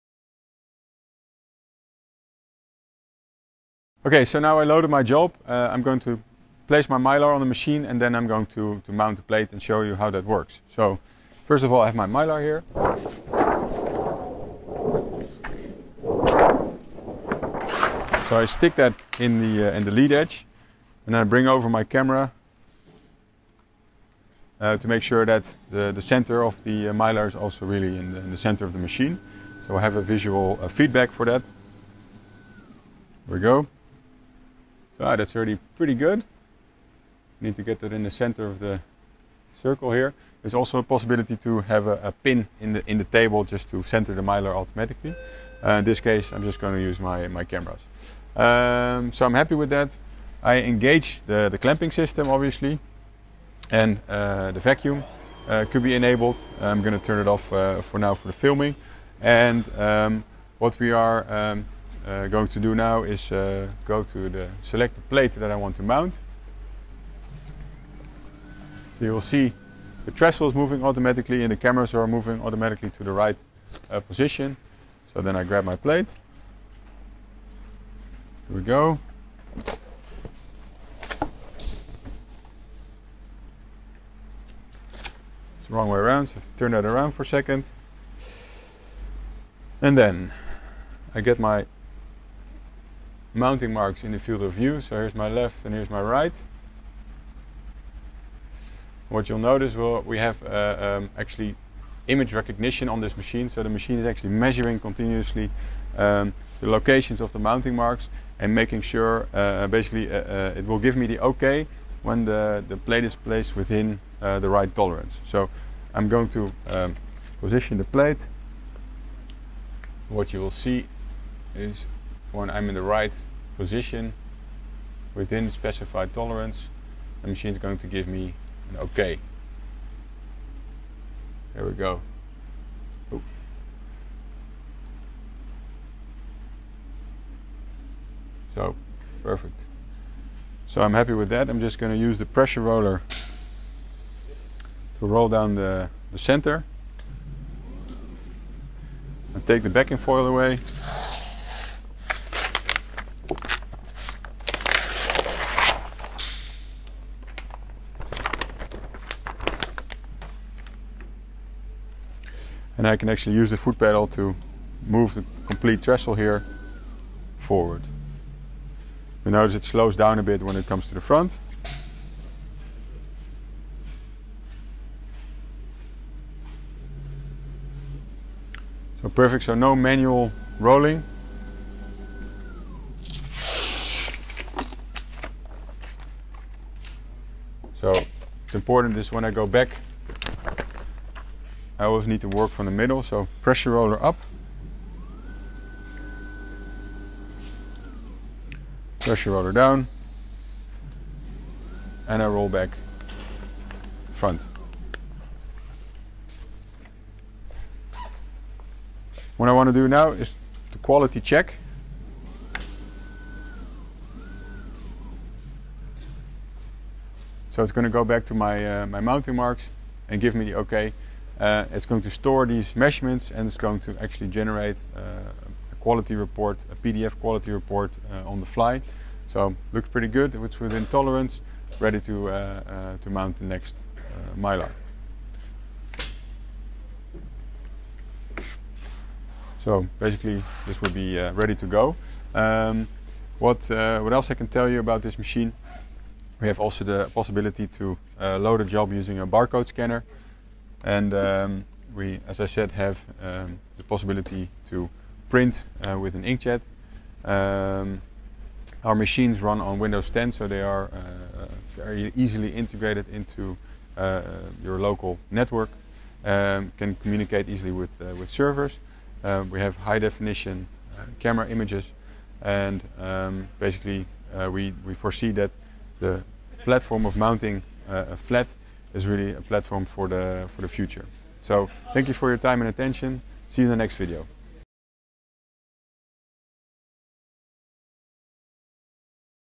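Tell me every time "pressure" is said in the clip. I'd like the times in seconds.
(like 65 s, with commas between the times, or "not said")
142 s, 193 s, 198 s.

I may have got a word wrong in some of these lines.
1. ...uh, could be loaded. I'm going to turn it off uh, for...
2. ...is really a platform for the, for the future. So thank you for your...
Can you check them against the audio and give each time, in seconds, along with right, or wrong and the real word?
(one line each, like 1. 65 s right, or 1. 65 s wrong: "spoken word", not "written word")
1. 55 s wrong: "enabled", not "loaded"
2. 278 s right.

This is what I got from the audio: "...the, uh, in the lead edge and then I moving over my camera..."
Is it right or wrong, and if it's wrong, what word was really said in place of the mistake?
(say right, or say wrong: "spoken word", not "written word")
wrong: "bring", not "moving".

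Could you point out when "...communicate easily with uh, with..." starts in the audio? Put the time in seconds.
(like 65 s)
266 s.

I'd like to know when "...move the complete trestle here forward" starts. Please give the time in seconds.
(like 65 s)
164 s.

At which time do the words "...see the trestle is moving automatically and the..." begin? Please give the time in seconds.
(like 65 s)
69 s.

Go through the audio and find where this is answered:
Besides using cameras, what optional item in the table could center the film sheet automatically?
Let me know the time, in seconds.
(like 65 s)
42 s.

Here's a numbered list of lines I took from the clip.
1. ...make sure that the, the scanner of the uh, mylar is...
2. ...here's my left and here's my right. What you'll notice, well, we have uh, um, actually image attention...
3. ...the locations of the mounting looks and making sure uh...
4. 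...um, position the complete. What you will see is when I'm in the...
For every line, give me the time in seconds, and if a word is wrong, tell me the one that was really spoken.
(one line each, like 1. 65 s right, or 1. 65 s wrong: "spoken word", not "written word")
1. 24 s wrong: "center", not "scanner"
2. 94 s wrong: "recognition", not "attention"
3. 106 s wrong: "marks", not "looks"
4. 116 s wrong: "plate", not "complete".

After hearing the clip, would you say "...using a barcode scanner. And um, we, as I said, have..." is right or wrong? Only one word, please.
right.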